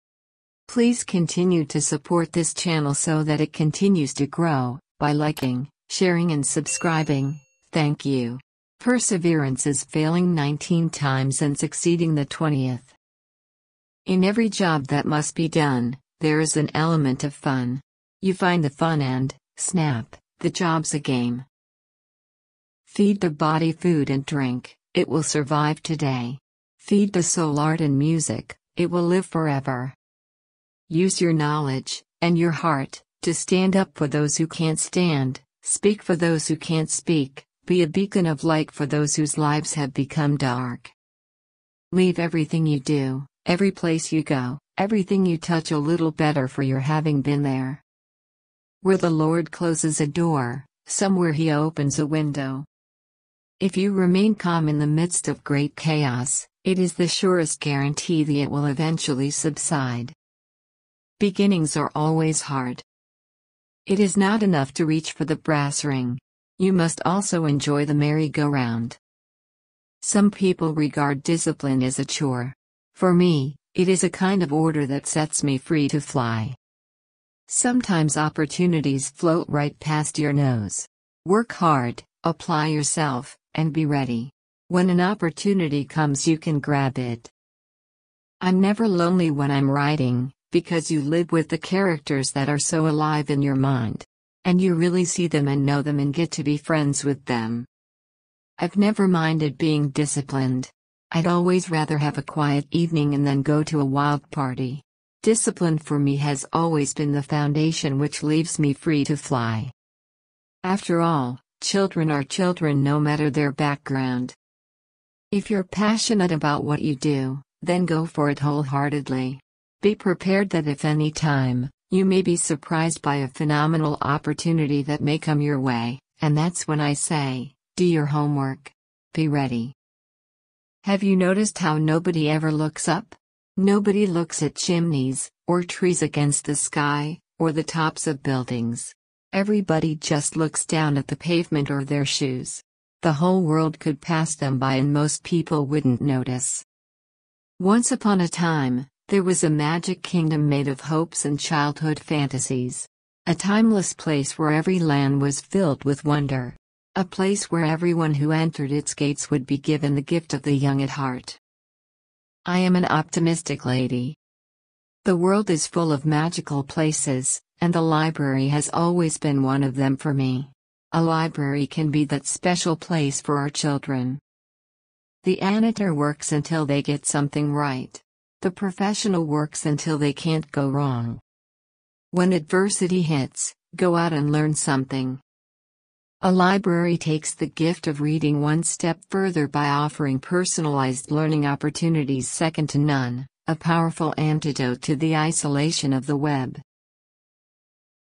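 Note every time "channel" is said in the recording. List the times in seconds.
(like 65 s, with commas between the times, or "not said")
2 s.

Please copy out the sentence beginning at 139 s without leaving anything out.
Everybody just looks down at the pavement or their shoes.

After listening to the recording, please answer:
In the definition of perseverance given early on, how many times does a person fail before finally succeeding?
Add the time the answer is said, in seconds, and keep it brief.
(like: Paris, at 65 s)
19, at 10 s.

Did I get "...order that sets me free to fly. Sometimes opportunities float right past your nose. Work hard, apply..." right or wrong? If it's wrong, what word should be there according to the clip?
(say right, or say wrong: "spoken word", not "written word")
right.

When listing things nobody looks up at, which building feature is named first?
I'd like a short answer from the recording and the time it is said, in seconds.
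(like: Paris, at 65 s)
chimneys, at 134 s.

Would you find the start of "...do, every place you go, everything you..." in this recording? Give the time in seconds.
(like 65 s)
42 s.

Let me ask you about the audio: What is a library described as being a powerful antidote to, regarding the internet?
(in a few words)
isolation of the web.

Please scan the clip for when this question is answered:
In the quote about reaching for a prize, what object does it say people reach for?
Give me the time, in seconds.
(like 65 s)
65 s.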